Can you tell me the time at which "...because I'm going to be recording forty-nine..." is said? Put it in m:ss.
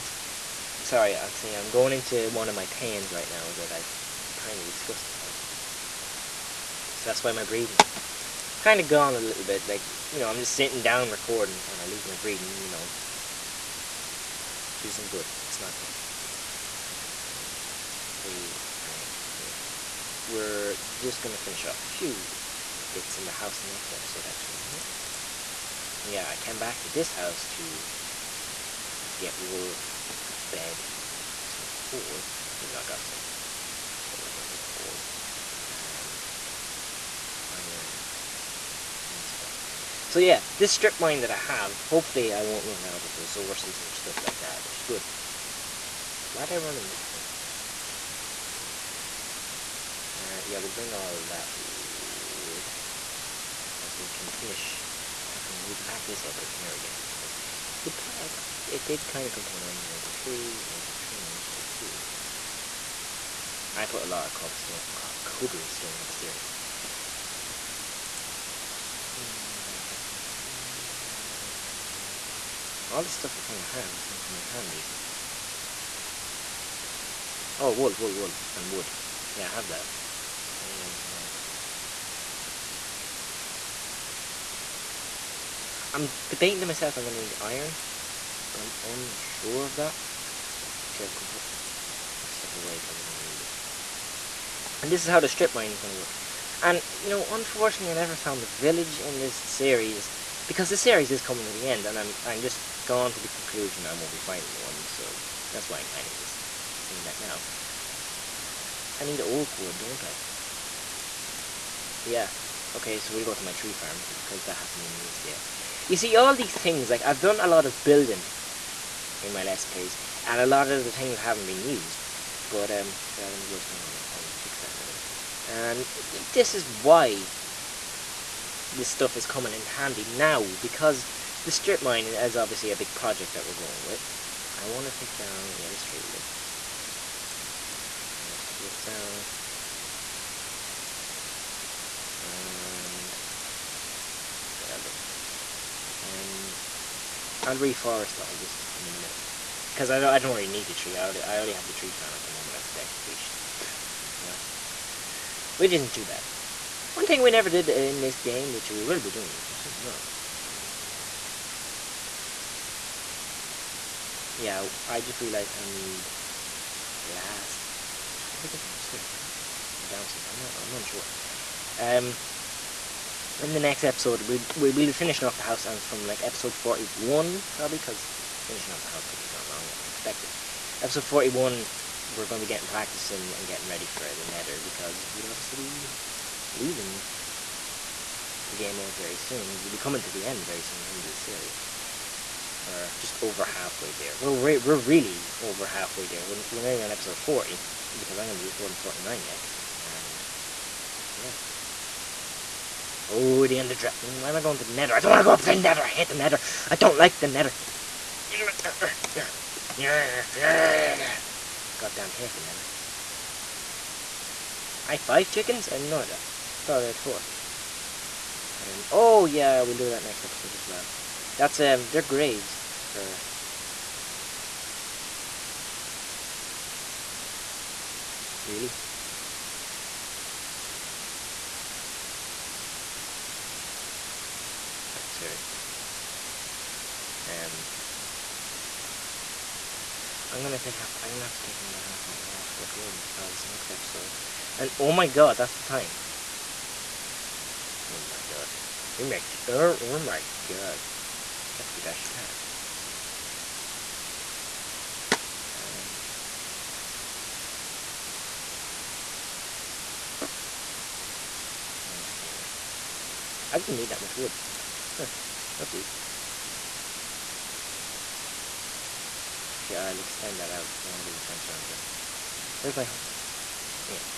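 3:17.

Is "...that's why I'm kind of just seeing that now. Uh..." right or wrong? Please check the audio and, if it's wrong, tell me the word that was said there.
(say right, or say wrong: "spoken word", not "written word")
right.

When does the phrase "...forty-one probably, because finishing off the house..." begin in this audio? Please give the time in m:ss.
2:56.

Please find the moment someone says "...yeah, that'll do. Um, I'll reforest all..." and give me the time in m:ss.
2:24.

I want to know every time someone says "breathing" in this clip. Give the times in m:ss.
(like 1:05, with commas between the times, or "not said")
0:07, 0:12.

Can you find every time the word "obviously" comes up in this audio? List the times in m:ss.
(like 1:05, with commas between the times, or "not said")
2:12, 3:05.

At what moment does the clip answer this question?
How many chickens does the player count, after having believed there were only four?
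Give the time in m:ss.
3:34.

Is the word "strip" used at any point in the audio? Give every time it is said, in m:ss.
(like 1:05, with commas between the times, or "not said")
0:40, 1:35, 2:11.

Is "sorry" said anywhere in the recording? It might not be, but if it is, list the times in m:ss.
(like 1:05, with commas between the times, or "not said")
0:00, 1:01.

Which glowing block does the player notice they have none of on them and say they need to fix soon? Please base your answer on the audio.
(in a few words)
glowstone.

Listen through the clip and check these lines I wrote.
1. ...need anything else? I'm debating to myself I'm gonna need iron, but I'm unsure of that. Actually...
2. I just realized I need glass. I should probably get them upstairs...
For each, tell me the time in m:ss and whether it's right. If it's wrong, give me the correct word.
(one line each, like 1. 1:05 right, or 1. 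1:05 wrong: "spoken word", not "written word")
1. 1:20 right
2. 2:44 right.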